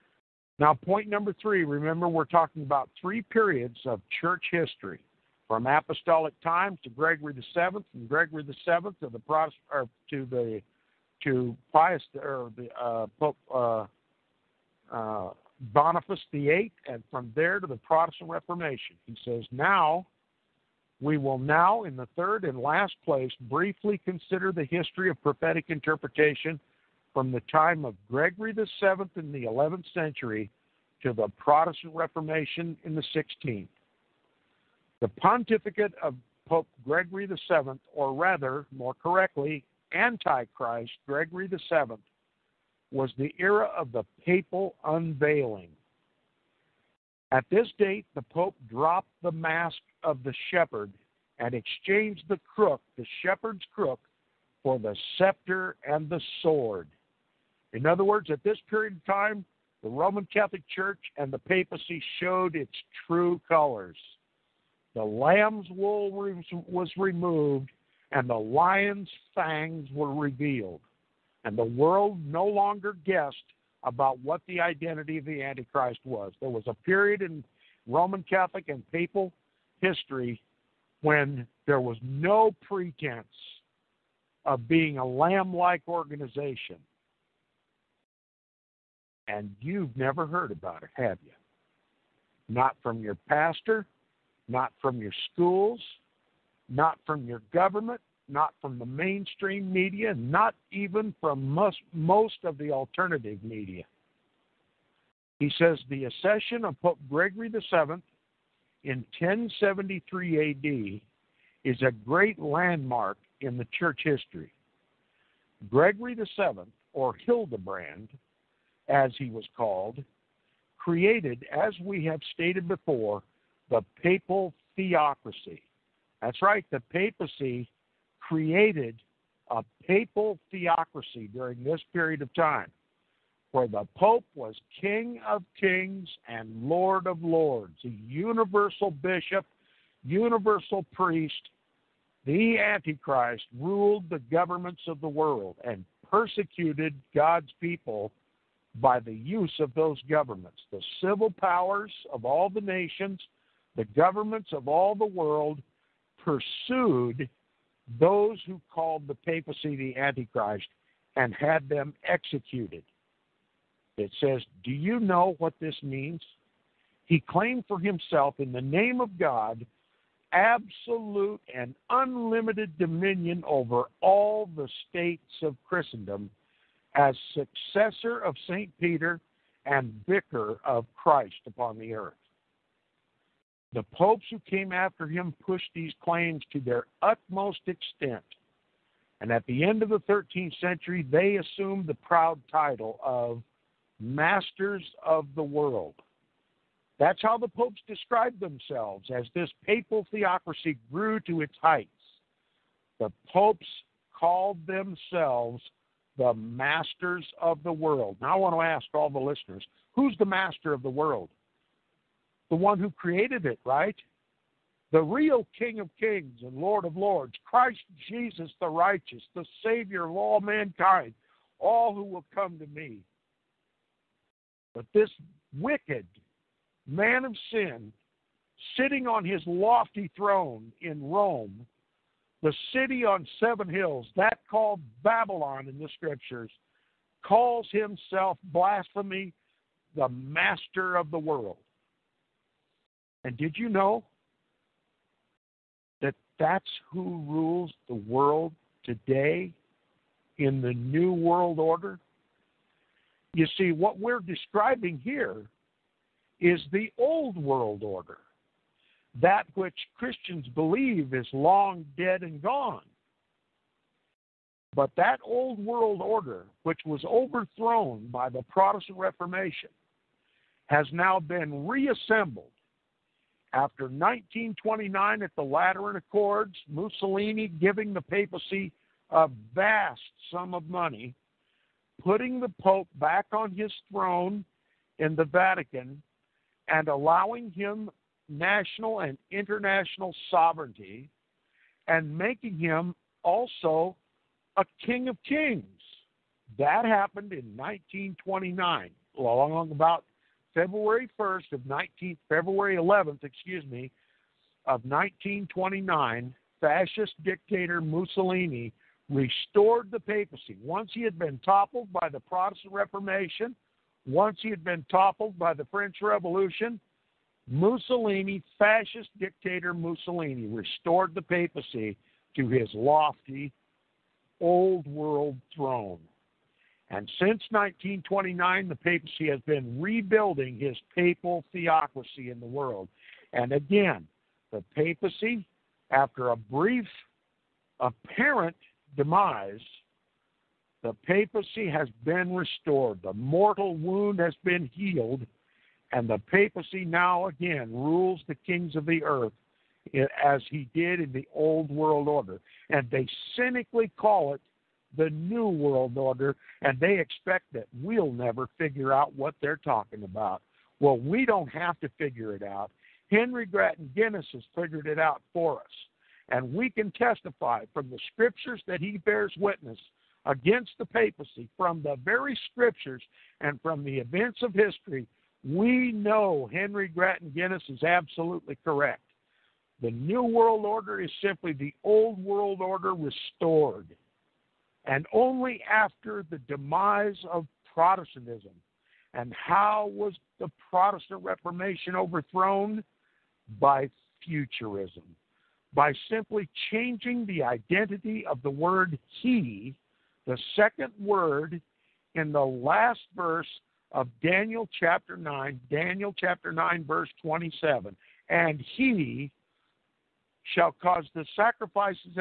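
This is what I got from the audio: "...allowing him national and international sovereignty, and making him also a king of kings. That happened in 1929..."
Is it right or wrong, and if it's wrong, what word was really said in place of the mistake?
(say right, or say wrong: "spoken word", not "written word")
right.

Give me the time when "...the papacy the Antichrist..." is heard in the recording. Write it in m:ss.
2:39.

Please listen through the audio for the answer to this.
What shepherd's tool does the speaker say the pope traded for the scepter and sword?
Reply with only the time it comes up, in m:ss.
0:52.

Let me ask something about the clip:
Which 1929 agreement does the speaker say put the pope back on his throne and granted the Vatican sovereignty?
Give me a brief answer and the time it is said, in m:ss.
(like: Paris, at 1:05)
Lateran Accords, at 4:35.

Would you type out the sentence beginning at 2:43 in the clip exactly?
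It says, Do you know what this means?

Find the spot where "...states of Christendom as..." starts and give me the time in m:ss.
2:54.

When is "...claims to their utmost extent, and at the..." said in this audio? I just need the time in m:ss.
3:06.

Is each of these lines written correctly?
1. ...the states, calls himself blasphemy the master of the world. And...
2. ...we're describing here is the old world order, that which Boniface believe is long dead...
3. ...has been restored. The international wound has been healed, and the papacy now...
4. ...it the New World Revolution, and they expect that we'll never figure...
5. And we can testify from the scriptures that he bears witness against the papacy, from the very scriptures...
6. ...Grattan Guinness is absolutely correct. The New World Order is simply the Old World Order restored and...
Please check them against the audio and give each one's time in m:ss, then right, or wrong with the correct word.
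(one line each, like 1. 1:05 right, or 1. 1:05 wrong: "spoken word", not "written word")
1. 3:55 wrong: "scriptures", not "states"
2. 4:13 wrong: "Christians", not "Boniface"
3. 5:41 wrong: "mortal", not "international"
4. 5:54 wrong: "Order", not "Revolution"
5. 6:06 right
6. 6:16 right.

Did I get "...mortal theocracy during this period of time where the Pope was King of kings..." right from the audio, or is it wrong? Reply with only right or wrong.
wrong.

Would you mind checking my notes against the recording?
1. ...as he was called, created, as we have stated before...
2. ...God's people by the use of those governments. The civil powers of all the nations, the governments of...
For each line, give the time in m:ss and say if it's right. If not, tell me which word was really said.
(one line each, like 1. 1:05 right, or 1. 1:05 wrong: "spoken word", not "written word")
1. 1:58 right
2. 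2:27 right.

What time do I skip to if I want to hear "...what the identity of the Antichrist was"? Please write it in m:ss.
1:14.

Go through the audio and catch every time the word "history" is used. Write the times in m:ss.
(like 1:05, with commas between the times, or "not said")
0:04, 0:24, 1:19, 1:54, 6:14.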